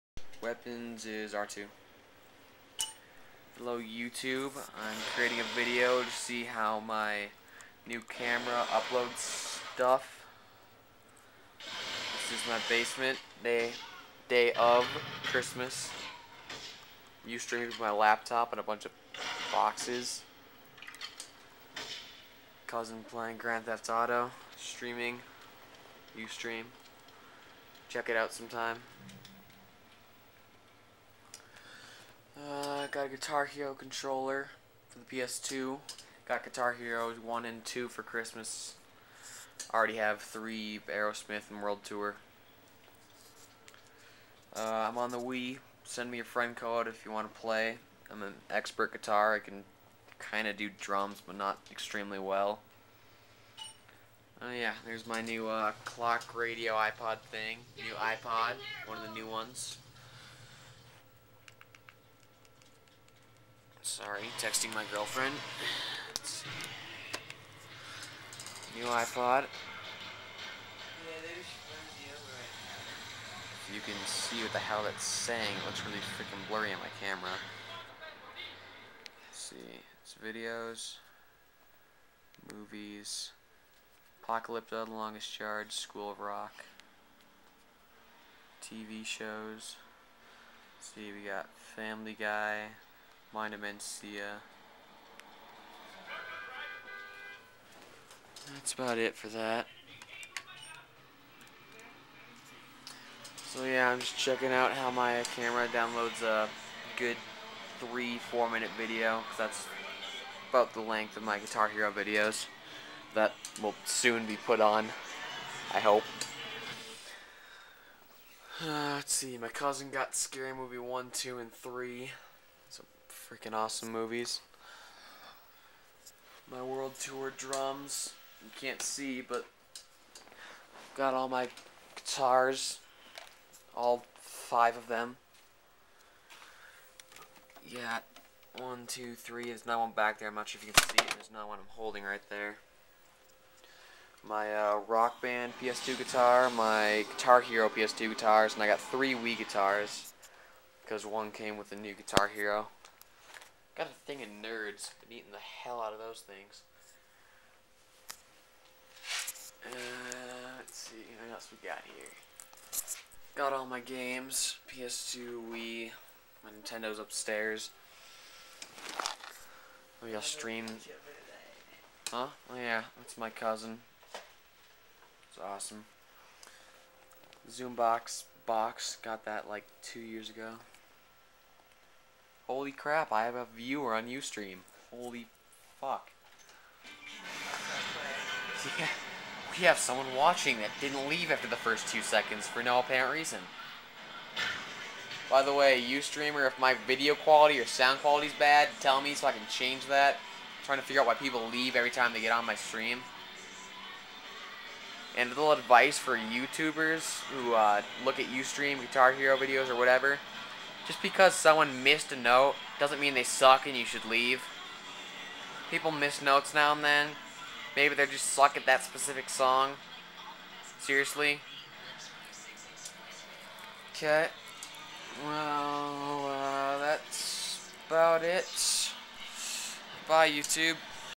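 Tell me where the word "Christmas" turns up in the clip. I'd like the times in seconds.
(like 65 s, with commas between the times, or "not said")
15 s, 38 s.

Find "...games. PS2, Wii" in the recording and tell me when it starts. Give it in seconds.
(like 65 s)
163 s.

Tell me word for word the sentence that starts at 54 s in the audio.
Oh uh, yeah, there's my new uh, clock radio iPod thing.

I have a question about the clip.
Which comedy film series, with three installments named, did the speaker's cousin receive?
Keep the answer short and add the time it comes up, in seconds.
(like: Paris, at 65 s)
Scary Movie, at 120 s.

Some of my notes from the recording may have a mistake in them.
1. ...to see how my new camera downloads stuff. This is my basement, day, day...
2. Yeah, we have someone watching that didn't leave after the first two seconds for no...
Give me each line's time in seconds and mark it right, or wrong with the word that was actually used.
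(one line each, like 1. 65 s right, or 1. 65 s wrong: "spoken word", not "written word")
1. 6 s wrong: "uploads", not "downloads"
2. 188 s right.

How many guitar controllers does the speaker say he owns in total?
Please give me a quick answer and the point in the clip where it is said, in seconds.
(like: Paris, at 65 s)
5, at 134 s.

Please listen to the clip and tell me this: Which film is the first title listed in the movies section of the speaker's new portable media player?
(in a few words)
Apocalypto.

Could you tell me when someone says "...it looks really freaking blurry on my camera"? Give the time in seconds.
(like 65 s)
75 s.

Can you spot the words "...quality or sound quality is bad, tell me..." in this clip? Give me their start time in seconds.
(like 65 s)
197 s.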